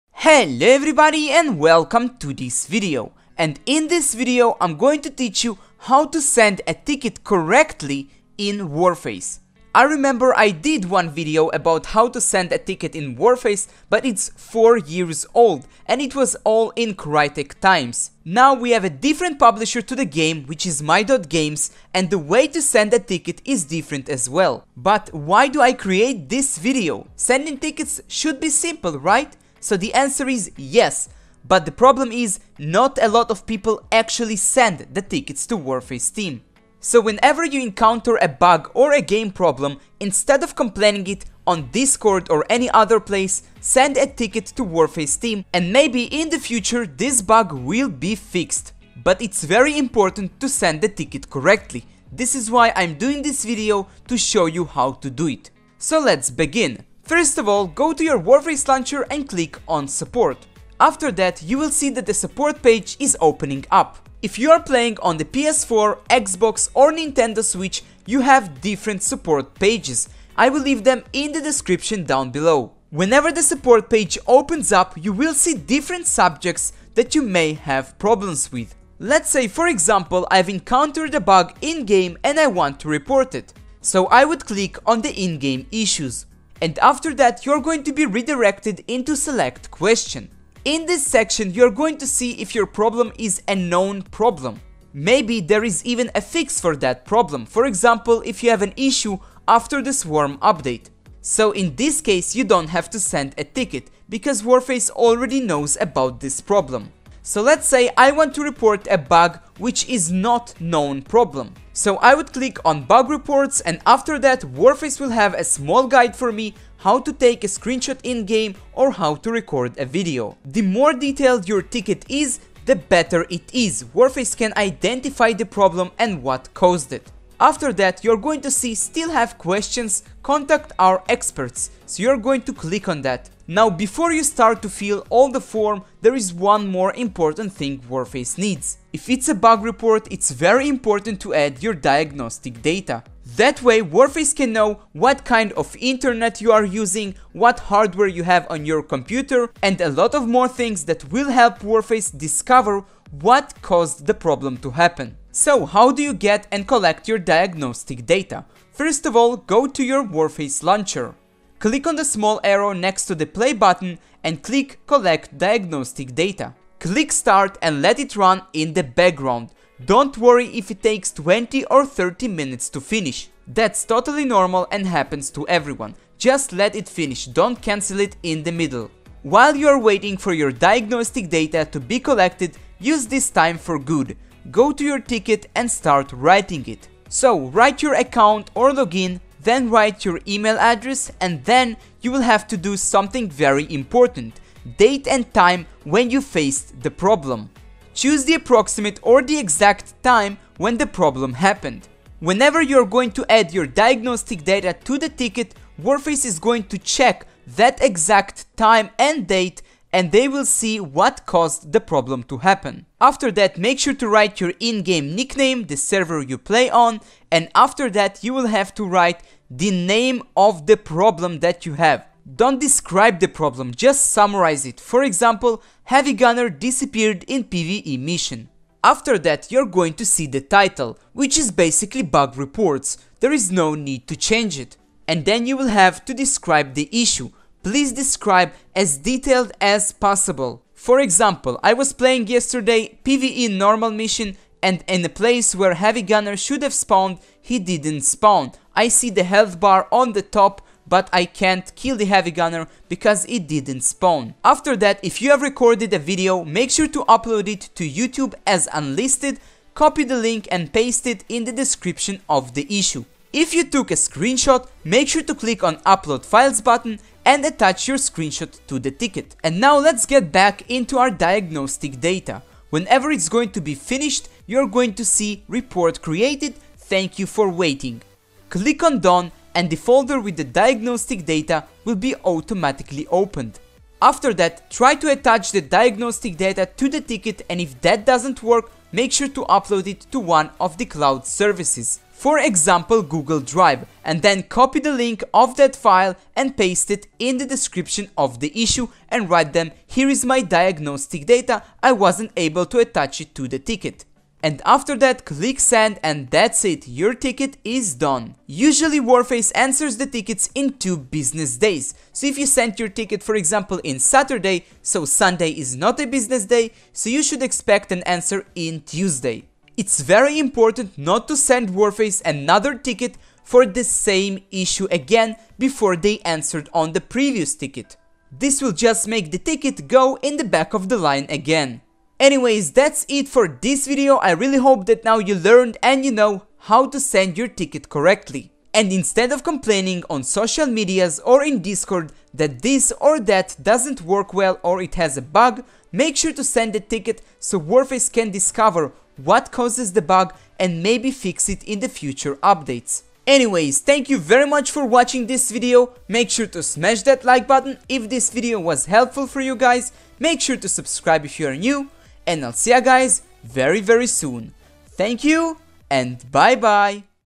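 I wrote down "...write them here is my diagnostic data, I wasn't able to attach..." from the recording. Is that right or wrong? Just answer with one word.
right.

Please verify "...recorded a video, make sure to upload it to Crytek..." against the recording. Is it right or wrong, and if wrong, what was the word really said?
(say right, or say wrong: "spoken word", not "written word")
wrong: "YouTube", not "Crytek".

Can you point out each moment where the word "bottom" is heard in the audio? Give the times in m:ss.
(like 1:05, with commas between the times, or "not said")
not said.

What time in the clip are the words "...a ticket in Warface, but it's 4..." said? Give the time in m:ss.
0:12.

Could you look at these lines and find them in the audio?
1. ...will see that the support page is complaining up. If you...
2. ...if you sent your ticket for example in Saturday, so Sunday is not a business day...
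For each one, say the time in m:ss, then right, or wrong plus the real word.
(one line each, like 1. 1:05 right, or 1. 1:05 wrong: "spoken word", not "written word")
1. 1:01 wrong: "opening", not "complaining"
2. 5:12 right.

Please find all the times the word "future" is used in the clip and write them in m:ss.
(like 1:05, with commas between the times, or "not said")
0:46, 5:51.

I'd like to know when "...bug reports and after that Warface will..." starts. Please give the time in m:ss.
1:52.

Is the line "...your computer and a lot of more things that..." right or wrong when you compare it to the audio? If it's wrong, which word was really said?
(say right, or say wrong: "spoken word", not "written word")
right.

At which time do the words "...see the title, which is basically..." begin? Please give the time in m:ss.
3:50.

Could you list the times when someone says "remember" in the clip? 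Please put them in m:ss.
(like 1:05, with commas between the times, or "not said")
0:09.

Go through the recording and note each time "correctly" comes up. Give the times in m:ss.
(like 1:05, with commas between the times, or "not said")
0:07, 0:51, 5:37.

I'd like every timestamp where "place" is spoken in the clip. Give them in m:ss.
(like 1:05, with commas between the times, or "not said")
0:42, 4:05.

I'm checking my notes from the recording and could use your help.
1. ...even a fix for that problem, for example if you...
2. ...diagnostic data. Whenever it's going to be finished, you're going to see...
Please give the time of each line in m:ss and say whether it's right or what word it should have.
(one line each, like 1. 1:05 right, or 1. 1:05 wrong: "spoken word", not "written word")
1. 1:35 right
2. 4:31 right.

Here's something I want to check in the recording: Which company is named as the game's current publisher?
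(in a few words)
my.games.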